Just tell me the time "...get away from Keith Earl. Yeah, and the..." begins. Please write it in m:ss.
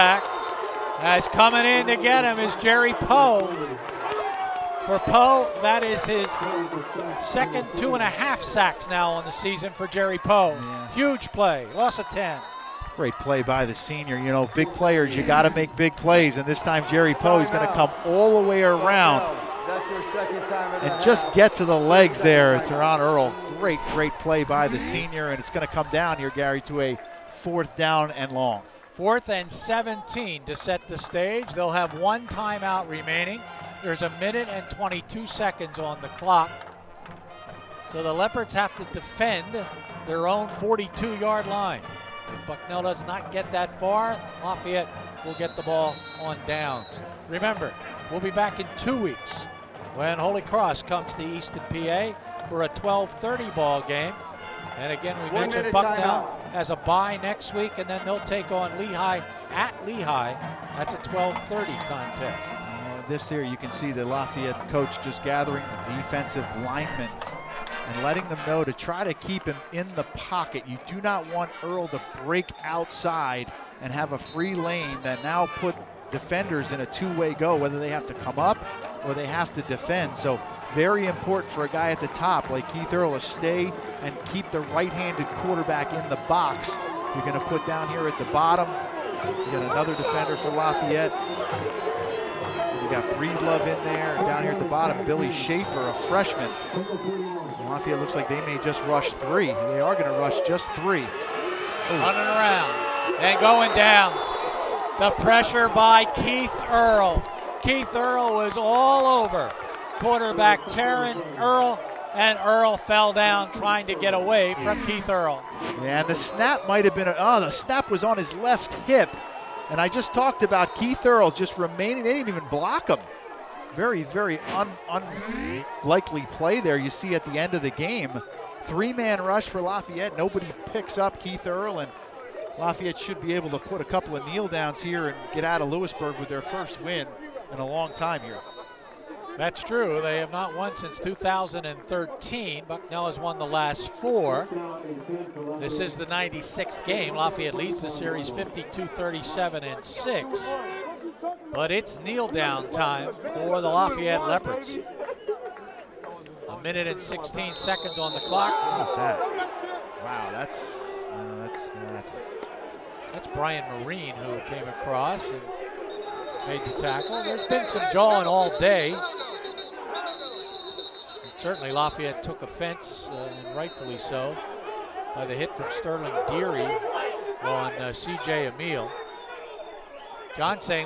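1:53.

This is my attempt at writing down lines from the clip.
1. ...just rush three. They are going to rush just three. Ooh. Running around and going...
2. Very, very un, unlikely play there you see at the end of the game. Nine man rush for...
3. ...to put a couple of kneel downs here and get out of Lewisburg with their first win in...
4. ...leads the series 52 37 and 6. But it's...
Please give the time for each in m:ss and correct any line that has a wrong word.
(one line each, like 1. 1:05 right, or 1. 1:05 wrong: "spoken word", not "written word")
1. 1:38 right
2. 2:03 wrong: "Three", not "Nine"
3. 2:13 right
4. 2:27 right.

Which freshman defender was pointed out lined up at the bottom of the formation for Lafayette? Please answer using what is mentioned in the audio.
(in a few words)
Billy Schaefer.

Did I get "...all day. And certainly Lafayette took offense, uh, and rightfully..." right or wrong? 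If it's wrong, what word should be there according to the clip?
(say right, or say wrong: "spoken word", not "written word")
right.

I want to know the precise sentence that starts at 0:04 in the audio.
For Poe, that is his second two and a half sacks now on the season for Jerry Poe.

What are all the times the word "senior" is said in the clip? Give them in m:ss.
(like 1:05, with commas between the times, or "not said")
0:13, 0:24.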